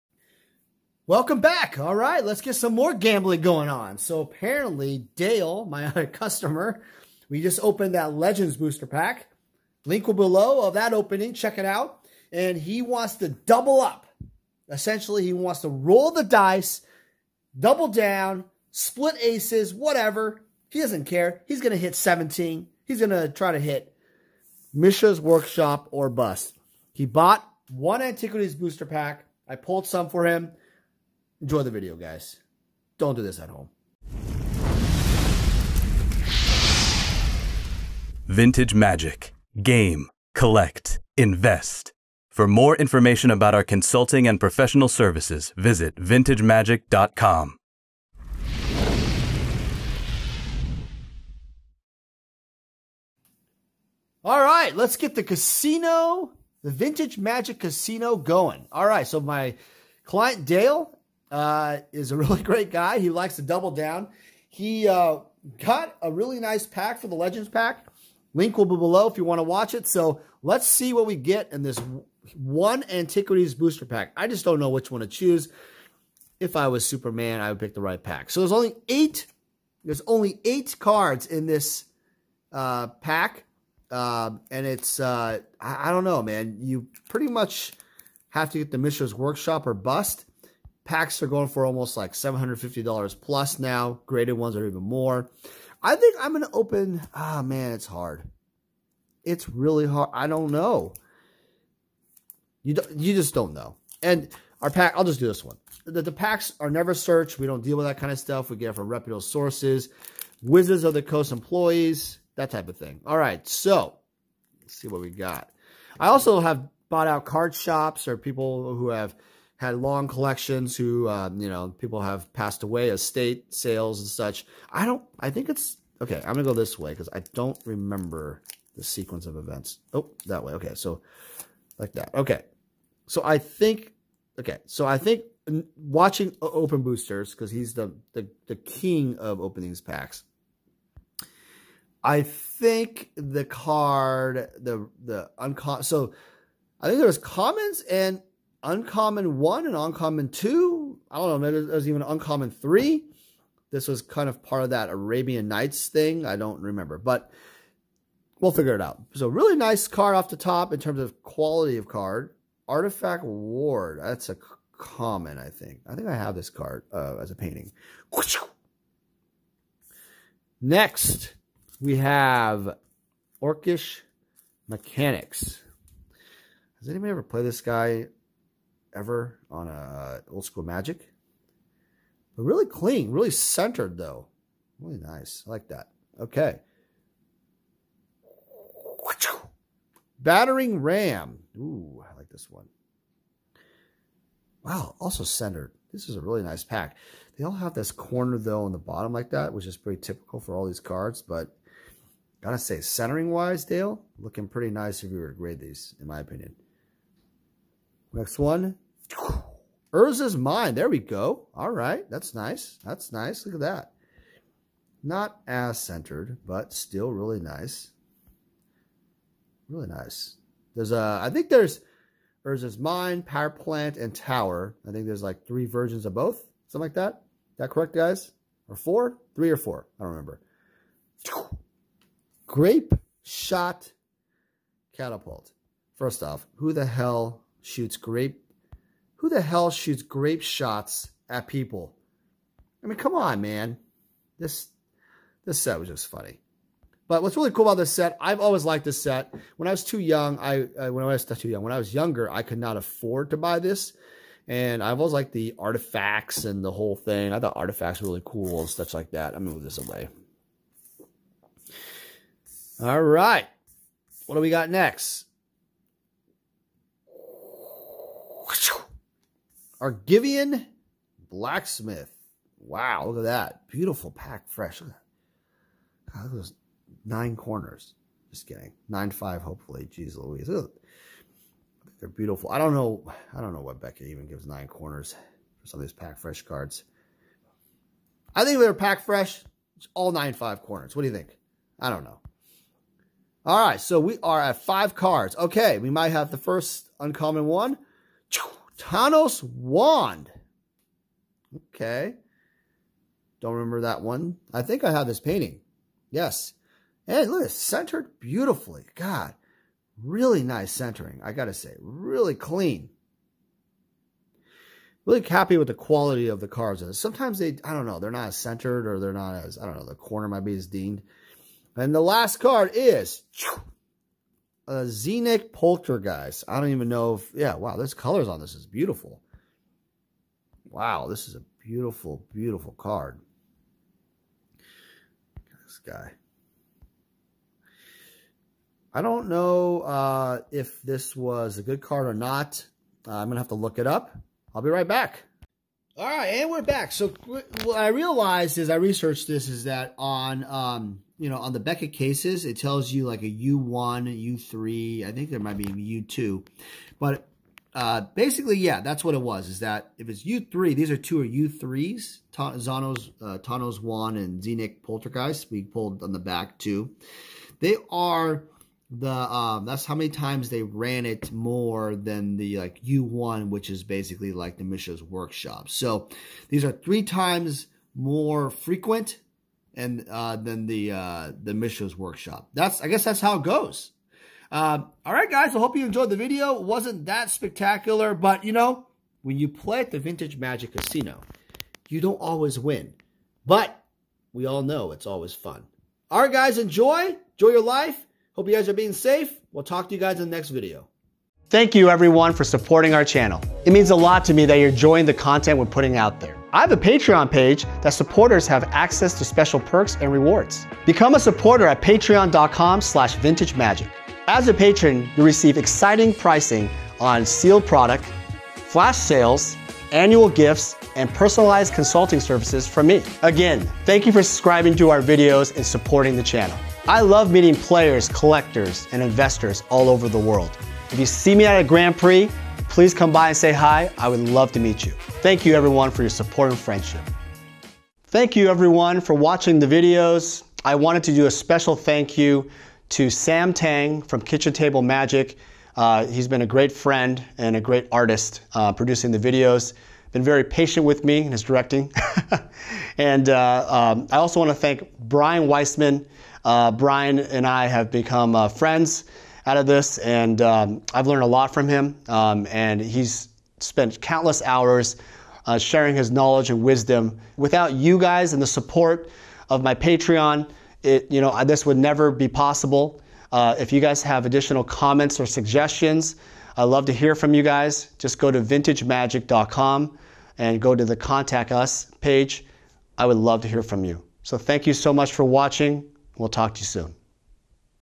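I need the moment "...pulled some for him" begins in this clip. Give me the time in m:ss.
0:29.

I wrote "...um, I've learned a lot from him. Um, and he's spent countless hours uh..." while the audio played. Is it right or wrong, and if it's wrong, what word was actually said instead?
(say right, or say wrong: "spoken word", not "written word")
right.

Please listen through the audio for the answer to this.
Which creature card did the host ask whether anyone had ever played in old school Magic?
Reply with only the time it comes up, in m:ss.
2:53.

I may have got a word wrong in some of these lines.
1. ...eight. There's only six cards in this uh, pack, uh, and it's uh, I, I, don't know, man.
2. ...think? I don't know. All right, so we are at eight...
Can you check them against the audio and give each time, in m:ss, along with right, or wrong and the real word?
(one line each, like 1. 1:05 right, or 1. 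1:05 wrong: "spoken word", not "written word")
1. 1:18 wrong: "eight", not "six"
2. 4:51 wrong: "five", not "eight".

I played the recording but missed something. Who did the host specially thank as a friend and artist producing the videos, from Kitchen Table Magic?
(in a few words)
Sam Tang.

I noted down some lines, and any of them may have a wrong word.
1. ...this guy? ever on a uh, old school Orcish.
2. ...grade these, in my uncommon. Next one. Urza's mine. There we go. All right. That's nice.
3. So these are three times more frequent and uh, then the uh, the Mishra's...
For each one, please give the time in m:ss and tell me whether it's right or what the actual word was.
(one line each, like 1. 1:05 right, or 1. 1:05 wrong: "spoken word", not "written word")
1. 2:57 wrong: "Magic", not "Orcish"
2. 3:25 wrong: "opinion", not "uncommon"
3. 6:15 right.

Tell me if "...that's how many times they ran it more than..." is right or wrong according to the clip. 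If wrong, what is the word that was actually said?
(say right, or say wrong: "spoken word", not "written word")
right.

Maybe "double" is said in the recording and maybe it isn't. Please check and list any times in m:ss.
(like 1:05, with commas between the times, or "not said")
0:13, 0:17, 1:03.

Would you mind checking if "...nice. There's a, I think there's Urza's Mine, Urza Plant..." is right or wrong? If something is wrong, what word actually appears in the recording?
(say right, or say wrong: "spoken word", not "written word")
wrong: "Power", not "Urza".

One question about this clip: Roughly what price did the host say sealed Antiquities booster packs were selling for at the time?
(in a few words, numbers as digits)
$750.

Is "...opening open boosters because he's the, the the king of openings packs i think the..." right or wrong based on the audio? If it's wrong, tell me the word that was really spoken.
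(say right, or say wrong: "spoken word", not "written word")
wrong: "watching", not "opening".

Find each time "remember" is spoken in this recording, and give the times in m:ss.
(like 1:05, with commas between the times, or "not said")
2:07, 2:36, 3:50, 5:03.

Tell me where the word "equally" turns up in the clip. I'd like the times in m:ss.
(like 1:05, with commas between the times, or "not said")
not said.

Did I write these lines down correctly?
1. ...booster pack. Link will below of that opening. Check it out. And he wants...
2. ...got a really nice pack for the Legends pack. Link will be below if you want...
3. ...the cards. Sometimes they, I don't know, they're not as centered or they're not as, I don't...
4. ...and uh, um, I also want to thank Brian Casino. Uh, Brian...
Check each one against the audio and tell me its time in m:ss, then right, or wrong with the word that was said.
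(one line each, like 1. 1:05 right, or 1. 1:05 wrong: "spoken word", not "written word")
1. 0:08 right
2. 1:05 right
3. 5:16 right
4. 7:32 wrong: "Weissman", not "Casino".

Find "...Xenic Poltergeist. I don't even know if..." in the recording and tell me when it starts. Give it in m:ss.
5:24.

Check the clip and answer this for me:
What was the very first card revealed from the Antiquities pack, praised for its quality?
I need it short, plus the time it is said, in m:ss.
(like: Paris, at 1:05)
Artifact Ward, at 2:42.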